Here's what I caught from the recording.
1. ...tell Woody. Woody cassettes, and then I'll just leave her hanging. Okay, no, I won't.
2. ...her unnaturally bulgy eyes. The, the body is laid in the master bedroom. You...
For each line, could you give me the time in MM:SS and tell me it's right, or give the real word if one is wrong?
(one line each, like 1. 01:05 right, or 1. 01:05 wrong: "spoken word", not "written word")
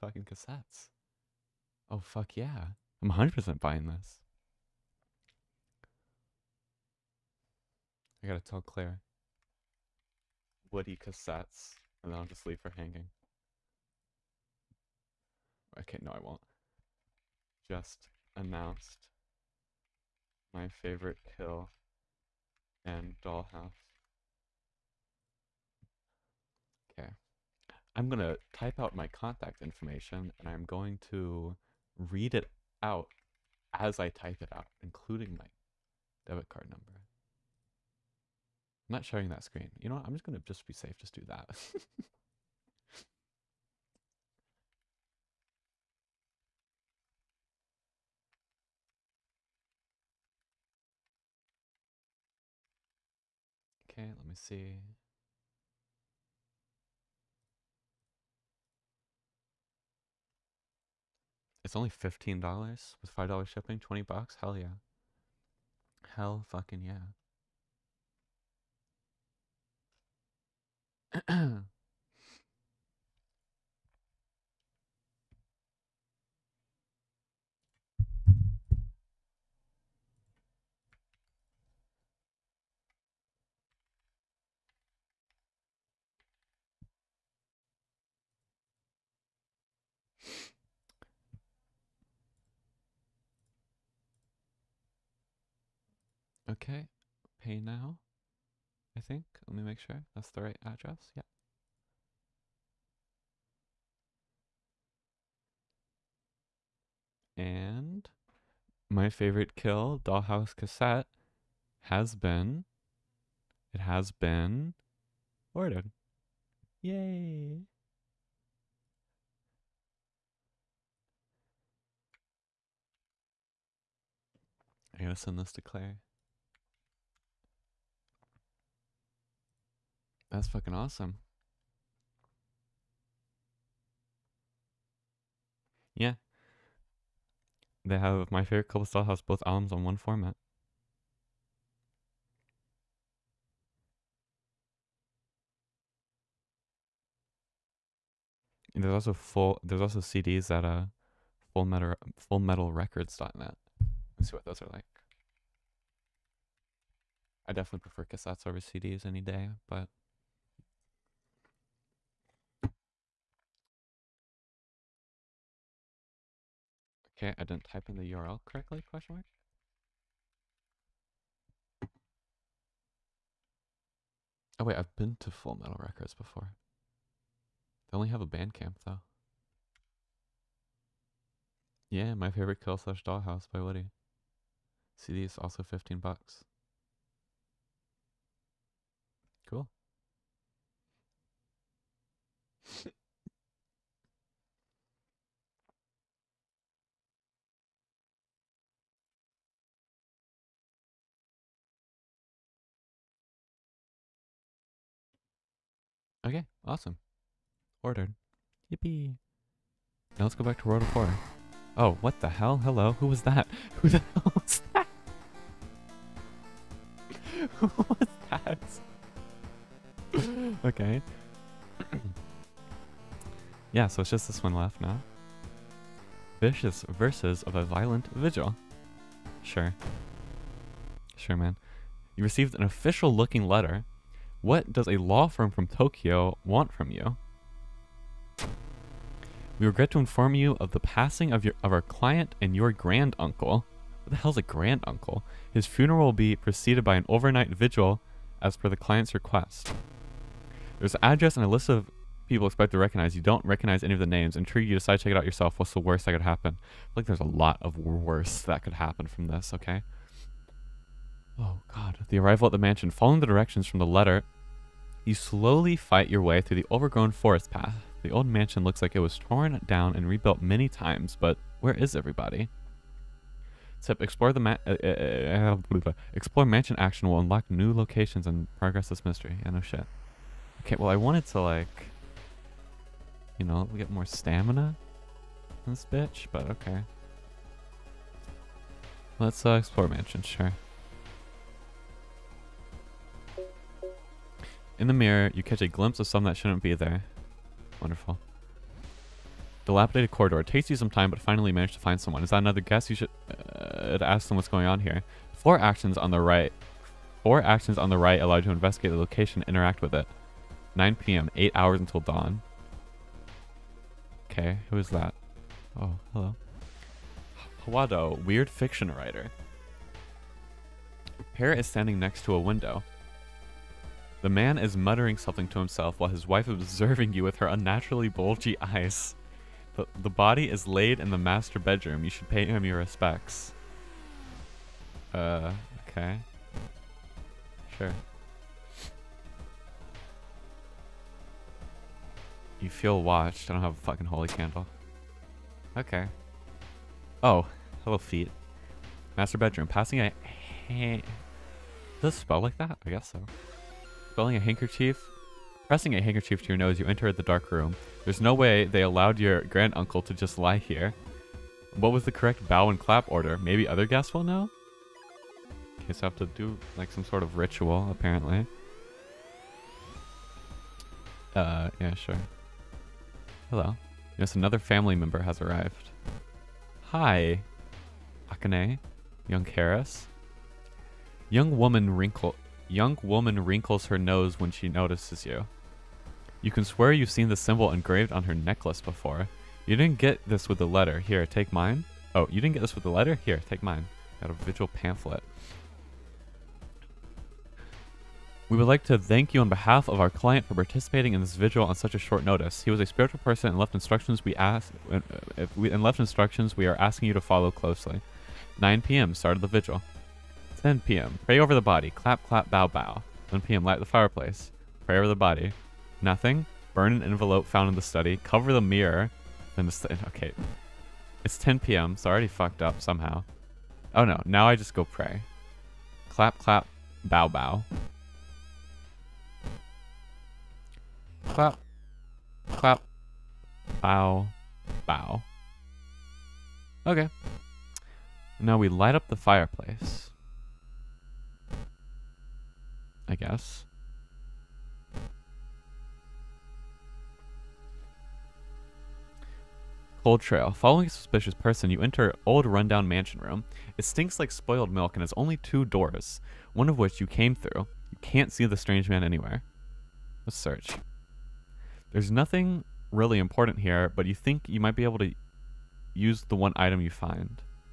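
1. 00:08 wrong: "Claire", not "Woody"
2. 05:27 right.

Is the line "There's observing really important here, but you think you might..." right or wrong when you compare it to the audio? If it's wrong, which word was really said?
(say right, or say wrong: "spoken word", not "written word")
wrong: "nothing", not "observing".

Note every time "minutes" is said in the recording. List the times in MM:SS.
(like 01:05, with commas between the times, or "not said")
not said.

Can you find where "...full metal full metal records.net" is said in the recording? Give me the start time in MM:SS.
02:31.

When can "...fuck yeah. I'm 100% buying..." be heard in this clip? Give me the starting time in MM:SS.
00:01.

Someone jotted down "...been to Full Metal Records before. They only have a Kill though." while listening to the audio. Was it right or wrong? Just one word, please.
wrong.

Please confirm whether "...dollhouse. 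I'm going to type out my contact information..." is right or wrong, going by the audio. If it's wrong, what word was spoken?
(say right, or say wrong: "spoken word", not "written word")
right.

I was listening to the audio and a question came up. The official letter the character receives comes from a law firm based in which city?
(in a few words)
Tokyo.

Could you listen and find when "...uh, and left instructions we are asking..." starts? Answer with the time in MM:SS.
06:45.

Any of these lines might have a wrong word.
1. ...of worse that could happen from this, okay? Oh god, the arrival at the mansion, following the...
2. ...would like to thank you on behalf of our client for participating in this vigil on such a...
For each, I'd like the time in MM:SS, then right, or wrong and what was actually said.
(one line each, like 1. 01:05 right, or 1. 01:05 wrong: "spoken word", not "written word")
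1. 04:17 right
2. 06:38 right.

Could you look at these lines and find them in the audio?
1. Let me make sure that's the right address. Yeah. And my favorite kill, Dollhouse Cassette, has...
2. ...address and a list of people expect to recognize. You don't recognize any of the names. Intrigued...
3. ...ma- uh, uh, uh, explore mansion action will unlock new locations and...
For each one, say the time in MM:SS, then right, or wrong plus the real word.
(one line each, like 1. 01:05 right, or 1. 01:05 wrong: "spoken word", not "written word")
1. 01:39 right
2. 04:11 right
3. 04:34 right.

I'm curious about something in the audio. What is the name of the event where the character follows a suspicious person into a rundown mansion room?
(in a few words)
Cold Trail.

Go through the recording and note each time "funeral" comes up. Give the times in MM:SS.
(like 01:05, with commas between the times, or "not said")
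04:05.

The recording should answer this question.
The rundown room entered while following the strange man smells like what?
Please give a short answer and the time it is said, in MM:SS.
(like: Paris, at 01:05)
Spoiled milk, at 07:34.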